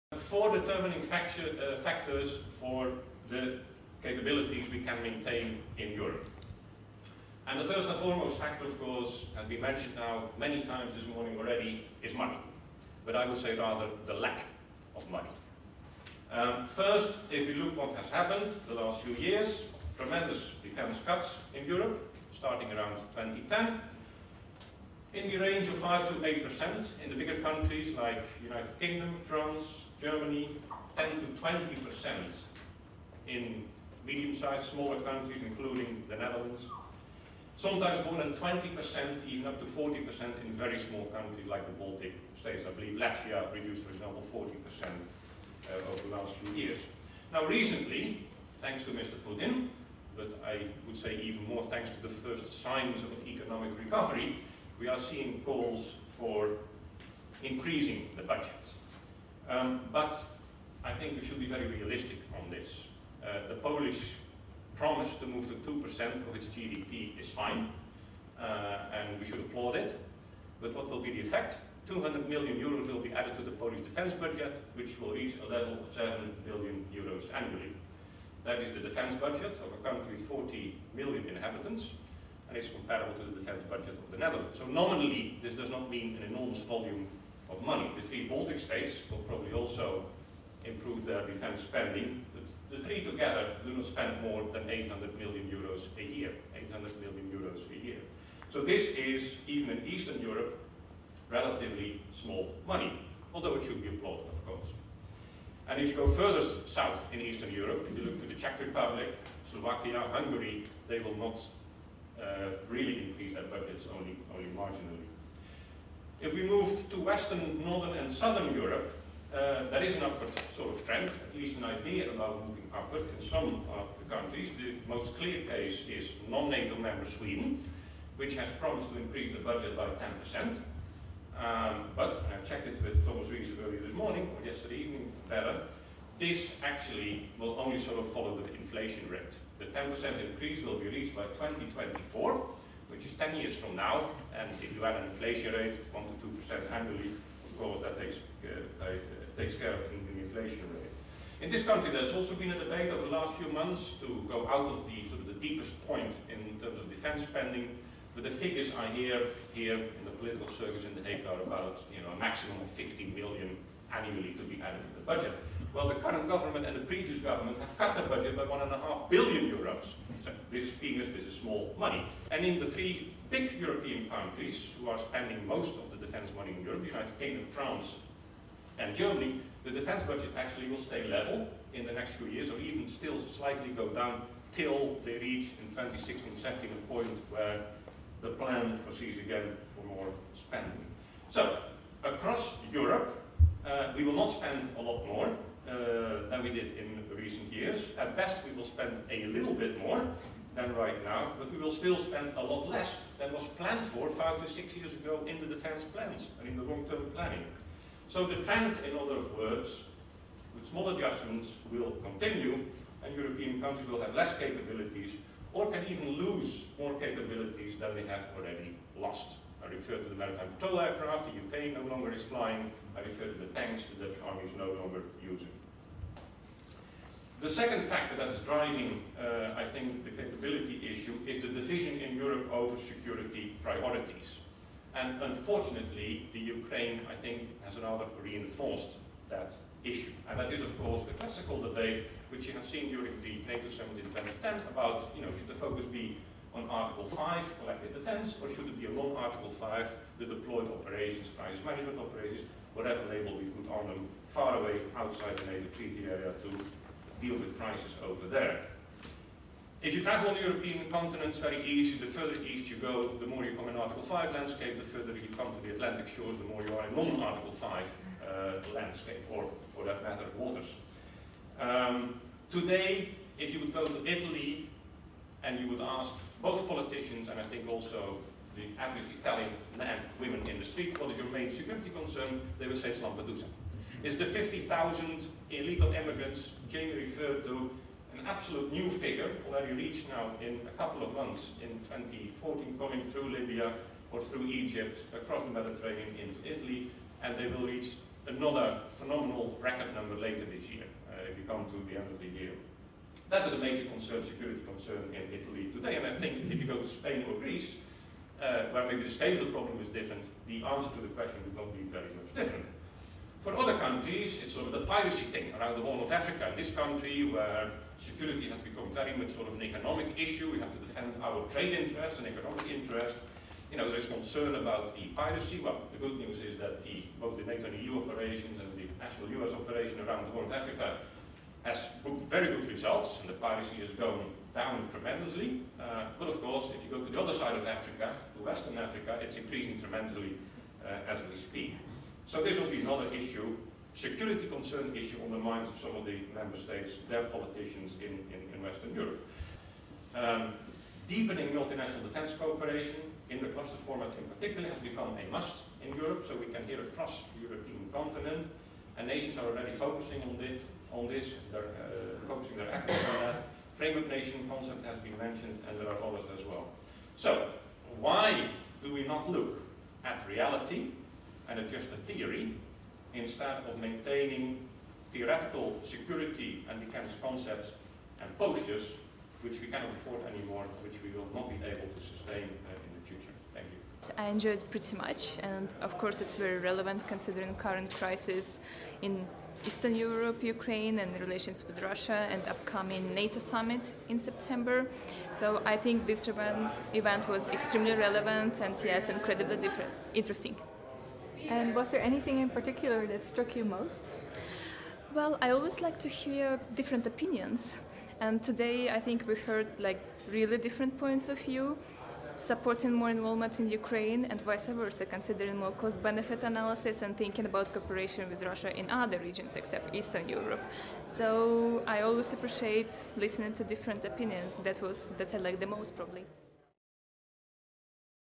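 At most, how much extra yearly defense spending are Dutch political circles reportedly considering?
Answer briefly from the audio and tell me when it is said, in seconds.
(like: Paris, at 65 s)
50 million, at 162 s.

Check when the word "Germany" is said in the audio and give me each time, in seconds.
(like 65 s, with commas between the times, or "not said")
30 s, 178 s.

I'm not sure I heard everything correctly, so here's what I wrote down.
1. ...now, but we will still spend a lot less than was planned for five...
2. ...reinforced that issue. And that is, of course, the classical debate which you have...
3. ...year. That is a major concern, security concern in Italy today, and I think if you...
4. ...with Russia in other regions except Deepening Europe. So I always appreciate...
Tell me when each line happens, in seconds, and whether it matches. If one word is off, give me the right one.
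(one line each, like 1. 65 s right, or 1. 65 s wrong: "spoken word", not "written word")
1. 201 s right
2. 238 s right
3. 302 s right
4. 418 s wrong: "Eastern", not "Deepening".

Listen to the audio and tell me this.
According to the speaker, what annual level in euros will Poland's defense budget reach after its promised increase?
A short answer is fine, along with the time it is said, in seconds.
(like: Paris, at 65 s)
7 billion euros, at 75 s.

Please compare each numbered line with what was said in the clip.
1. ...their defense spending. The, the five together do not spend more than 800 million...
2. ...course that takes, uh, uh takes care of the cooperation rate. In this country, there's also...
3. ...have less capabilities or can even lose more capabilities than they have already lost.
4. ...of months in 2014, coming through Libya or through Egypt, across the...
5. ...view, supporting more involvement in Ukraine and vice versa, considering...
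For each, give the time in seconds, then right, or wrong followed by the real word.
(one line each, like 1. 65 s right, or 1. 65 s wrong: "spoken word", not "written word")
1. 91 s wrong: "three", not "five"
2. 147 s wrong: "inflation", not "cooperation"
3. 214 s right
4. 291 s right
5. 411 s right.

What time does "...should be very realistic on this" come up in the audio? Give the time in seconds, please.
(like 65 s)
61 s.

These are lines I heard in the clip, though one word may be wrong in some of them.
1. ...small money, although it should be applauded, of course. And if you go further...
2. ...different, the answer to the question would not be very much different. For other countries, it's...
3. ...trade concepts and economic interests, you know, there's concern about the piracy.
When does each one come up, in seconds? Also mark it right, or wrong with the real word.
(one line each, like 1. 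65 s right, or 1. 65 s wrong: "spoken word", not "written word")
1. 102 s right
2. 309 s right
3. 321 s wrong: "interests", not "concepts".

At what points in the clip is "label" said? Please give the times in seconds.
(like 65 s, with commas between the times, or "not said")
253 s.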